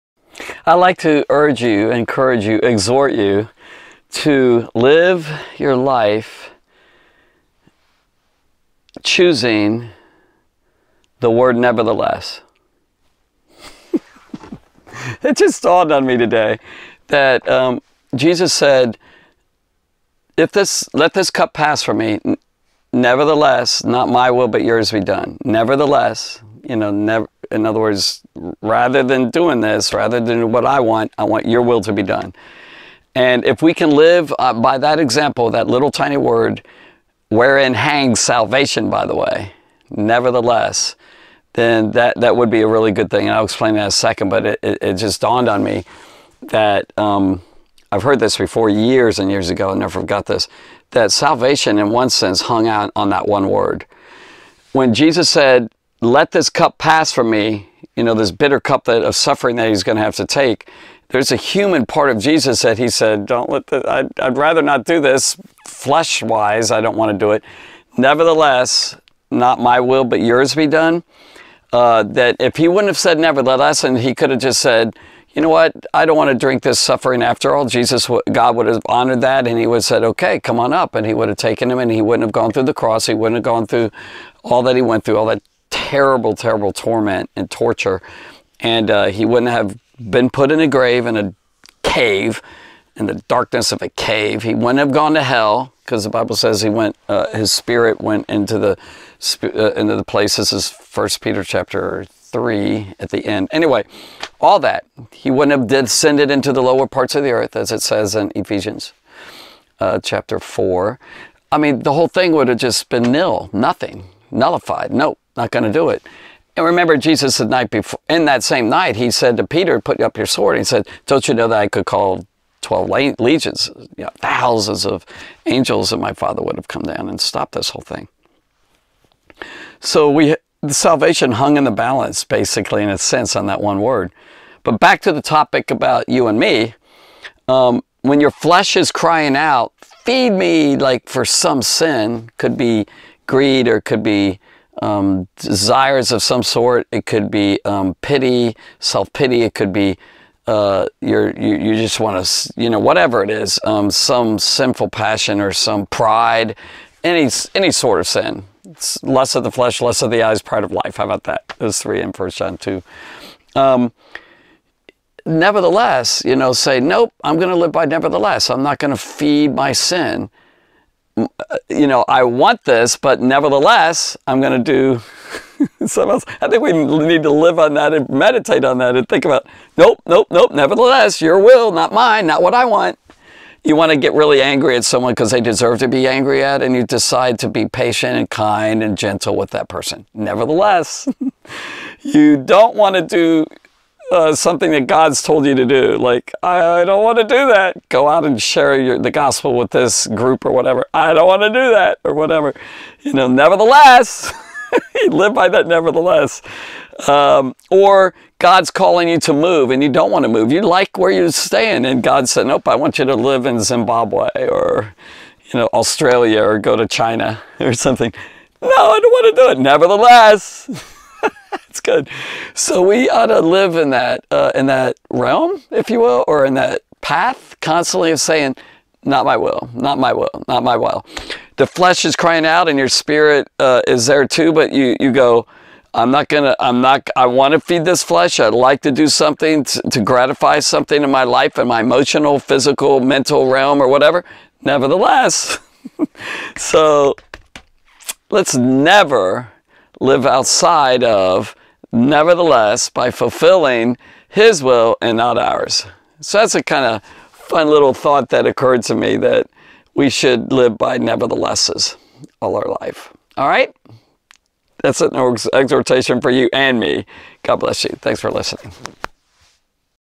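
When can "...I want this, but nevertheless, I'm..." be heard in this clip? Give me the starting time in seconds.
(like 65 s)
172 s.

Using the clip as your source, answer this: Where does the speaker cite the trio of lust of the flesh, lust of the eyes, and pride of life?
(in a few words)
First John 2.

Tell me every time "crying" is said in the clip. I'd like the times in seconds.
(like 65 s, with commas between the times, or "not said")
138 s, 232 s.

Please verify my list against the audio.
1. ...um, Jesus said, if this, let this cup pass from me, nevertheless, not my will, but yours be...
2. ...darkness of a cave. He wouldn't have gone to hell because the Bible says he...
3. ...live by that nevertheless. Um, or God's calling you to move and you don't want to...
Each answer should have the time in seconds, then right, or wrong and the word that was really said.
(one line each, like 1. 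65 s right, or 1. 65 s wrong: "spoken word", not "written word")
1. 17 s right
2. 93 s right
3. 205 s right.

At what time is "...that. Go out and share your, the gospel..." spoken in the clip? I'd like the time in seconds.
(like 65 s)
197 s.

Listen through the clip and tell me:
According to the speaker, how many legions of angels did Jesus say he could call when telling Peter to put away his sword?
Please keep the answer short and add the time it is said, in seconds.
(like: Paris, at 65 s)
12, at 122 s.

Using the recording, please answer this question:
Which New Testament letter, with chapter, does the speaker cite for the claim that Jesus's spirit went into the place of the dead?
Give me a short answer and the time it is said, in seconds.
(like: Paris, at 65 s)
First Peter 3, at 100 s.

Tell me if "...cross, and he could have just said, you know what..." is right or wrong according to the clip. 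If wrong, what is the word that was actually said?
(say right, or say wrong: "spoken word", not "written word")
wrong: "nevertheless", not "cross".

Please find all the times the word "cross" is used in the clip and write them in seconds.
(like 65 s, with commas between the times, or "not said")
82 s.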